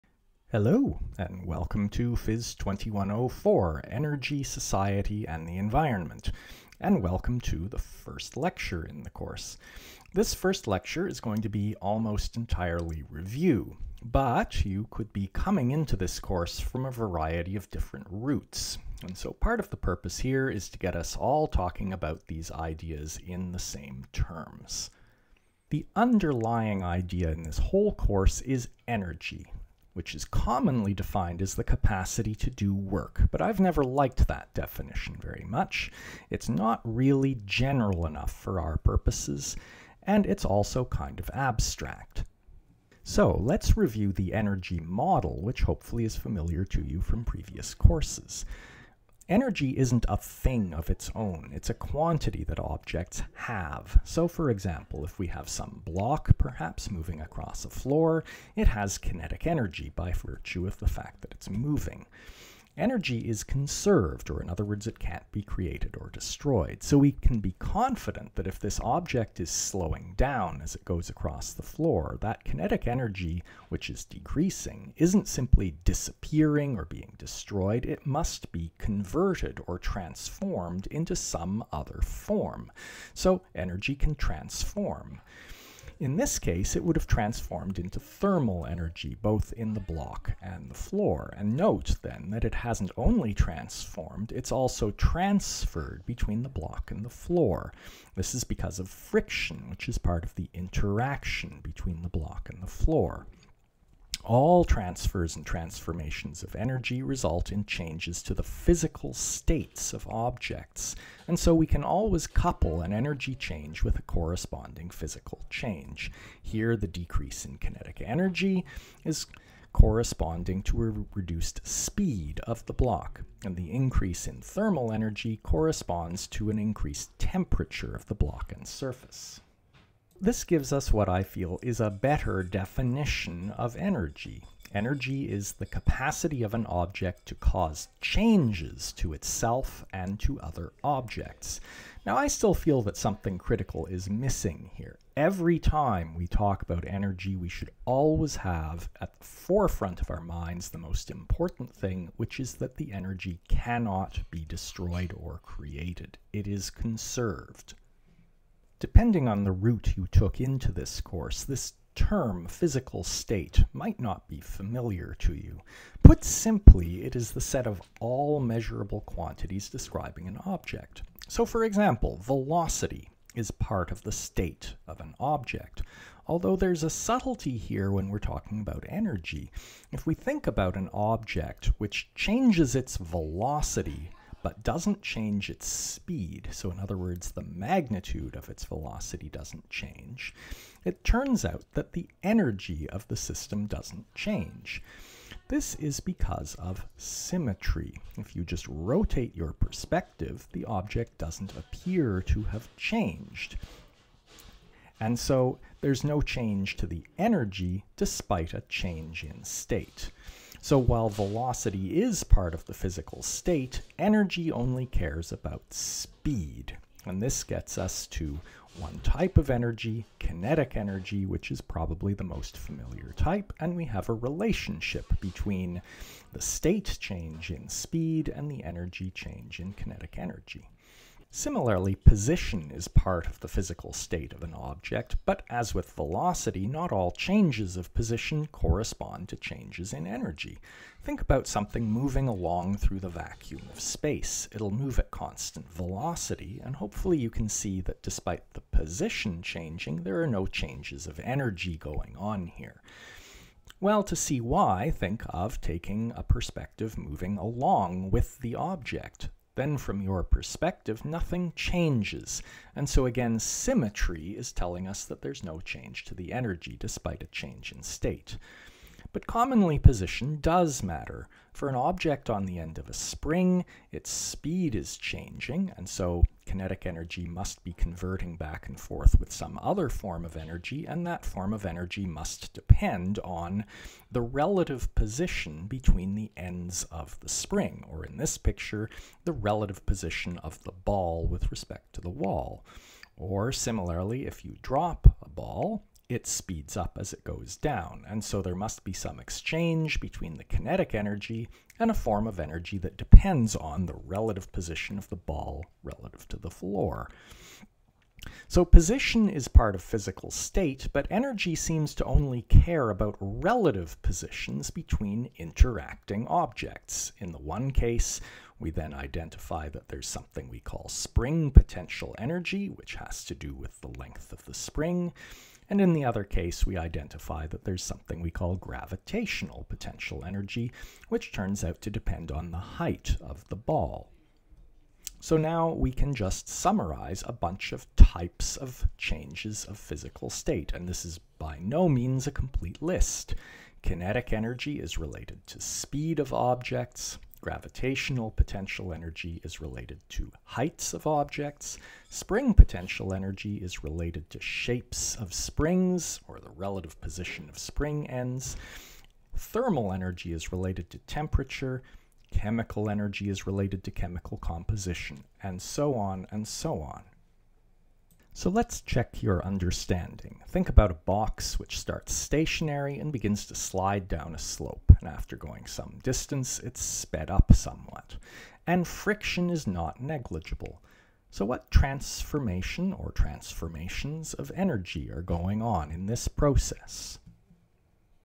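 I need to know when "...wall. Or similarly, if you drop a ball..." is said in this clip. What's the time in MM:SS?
04:52.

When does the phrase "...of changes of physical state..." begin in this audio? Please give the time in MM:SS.
05:38.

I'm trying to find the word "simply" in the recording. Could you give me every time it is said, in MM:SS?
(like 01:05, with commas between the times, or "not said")
01:15, 02:46.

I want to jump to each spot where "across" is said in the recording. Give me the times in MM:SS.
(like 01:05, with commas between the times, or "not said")
00:57, 01:11.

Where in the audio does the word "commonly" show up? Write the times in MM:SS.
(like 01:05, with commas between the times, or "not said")
00:30, 04:29.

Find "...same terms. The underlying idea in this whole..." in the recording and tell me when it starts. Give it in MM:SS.
00:23.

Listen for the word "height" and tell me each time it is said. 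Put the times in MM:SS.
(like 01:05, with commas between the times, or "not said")
05:32, 05:50.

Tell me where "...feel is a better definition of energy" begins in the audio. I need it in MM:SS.
02:11.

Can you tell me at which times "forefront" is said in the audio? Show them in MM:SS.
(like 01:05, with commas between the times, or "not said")
02:29.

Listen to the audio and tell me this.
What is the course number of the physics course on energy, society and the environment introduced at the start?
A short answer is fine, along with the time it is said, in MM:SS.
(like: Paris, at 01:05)
Phys 2104, at 00:02.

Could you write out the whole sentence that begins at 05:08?
So position is part of physical state, but energy seems to only care about relative positions between interacting objects.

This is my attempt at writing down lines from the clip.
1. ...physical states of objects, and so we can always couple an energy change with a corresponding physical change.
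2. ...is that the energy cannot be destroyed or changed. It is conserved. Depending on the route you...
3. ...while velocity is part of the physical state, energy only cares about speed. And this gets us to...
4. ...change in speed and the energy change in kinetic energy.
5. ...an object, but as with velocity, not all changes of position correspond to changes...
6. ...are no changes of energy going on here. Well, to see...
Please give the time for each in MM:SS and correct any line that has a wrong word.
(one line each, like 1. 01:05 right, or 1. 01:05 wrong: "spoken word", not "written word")
1. 01:48 right
2. 02:32 wrong: "created", not "changed"
3. 03:30 right
4. 03:47 right
5. 03:54 right
6. 04:10 right.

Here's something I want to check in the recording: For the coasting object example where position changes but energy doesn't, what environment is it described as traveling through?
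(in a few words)
the vacuum of space.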